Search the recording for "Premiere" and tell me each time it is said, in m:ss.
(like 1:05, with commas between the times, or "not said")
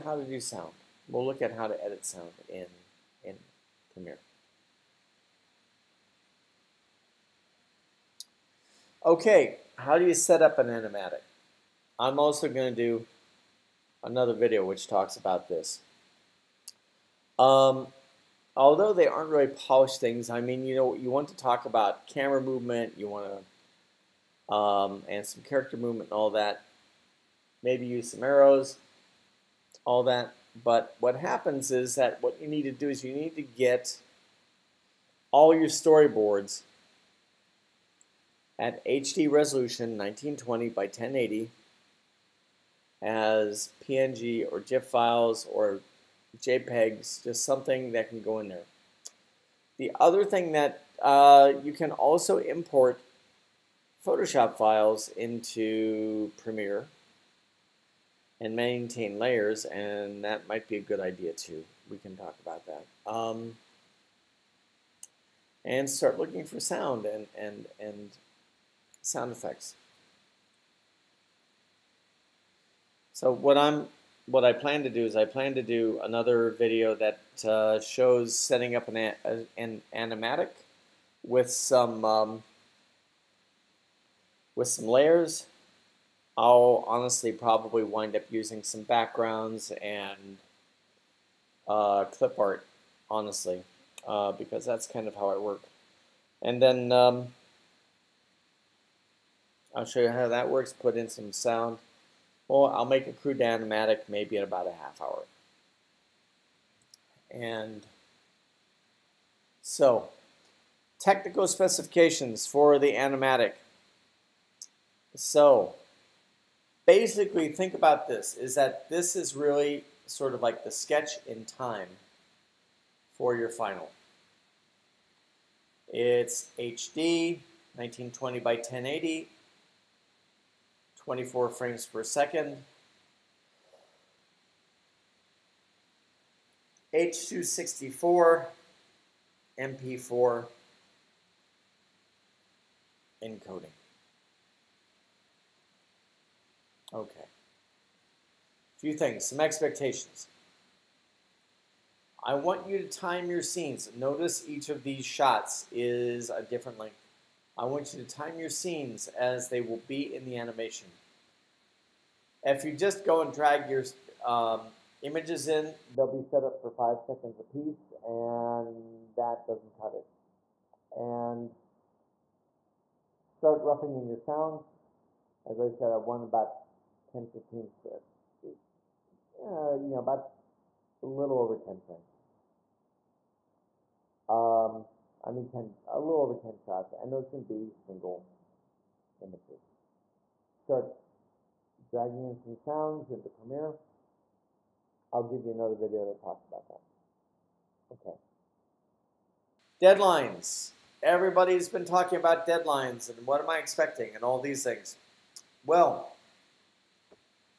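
0:03, 0:56, 3:13.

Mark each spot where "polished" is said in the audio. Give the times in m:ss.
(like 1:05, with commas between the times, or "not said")
0:19.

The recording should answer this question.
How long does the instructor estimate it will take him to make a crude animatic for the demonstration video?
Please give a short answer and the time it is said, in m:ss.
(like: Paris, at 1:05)
half hour, at 1:44.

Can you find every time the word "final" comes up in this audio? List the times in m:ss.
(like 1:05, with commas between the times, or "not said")
2:03.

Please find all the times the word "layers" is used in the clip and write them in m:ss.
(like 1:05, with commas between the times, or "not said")
0:59, 1:24.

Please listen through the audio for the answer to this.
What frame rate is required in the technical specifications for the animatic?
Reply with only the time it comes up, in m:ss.
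2:11.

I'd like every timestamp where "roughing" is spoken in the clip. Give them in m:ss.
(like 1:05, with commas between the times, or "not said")
2:53.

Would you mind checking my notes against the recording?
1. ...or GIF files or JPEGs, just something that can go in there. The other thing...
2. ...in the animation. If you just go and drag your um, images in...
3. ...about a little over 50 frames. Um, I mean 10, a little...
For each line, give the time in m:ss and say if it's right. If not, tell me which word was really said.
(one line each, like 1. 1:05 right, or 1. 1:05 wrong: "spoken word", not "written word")
1. 0:44 right
2. 2:40 right
3. 2:59 wrong: "10", not "50".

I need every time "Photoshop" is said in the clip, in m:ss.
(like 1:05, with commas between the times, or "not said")
0:54.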